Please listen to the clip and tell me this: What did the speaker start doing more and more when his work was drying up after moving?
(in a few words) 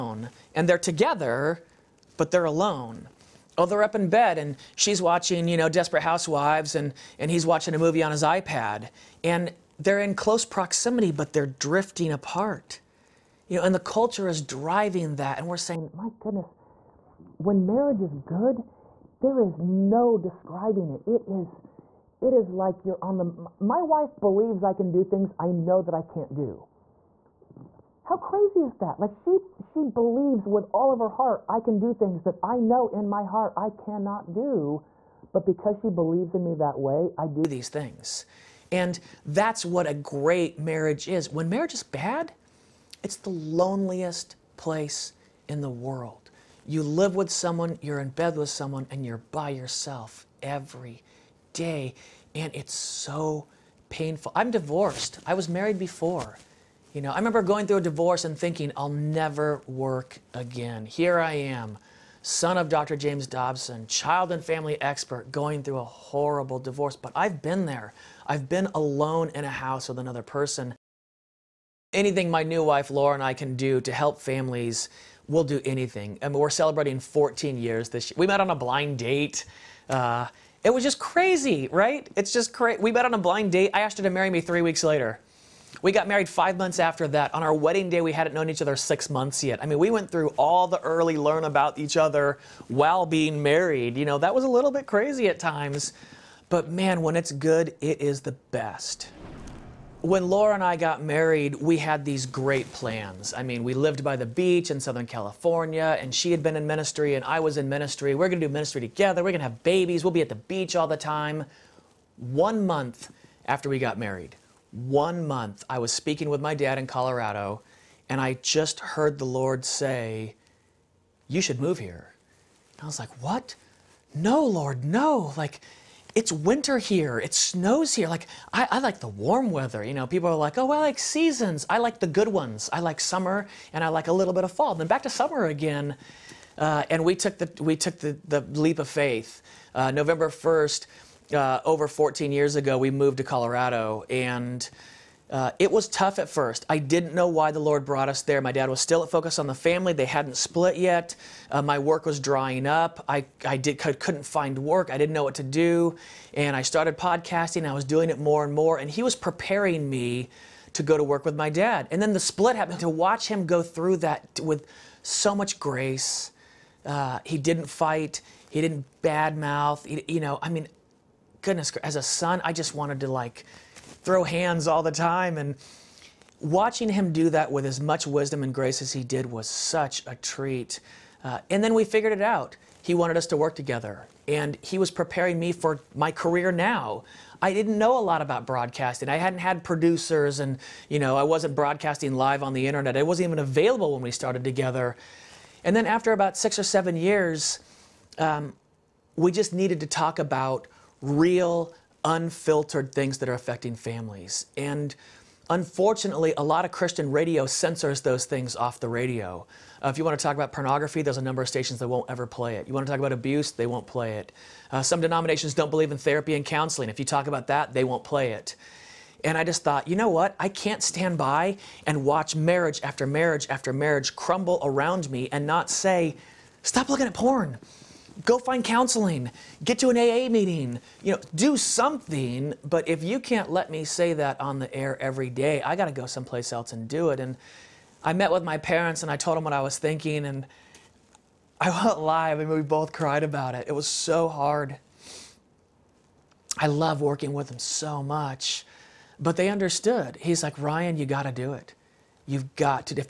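Podcasting.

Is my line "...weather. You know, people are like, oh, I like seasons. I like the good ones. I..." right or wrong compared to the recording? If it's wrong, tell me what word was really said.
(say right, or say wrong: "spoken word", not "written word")
right.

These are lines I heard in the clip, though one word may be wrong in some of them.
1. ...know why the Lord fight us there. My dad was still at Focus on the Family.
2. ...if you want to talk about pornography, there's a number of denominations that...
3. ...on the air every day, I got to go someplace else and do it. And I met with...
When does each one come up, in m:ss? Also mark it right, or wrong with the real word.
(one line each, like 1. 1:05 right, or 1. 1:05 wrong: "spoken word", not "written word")
1. 2:27 wrong: "brought", not "fight"
2. 3:29 wrong: "stations", not "denominations"
3. 3:54 right.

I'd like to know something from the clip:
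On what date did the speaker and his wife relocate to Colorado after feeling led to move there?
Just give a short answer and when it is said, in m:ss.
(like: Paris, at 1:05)
November 1st, at 2:19.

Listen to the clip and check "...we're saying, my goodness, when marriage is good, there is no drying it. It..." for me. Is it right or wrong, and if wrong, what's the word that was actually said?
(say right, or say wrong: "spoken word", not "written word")
wrong: "describing", not "drying".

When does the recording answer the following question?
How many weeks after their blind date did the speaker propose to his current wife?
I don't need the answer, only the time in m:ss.
1:24.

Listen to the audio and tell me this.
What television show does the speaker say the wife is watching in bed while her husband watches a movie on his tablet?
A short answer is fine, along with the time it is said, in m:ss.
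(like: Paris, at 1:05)
Desperate Housewives, at 0:05.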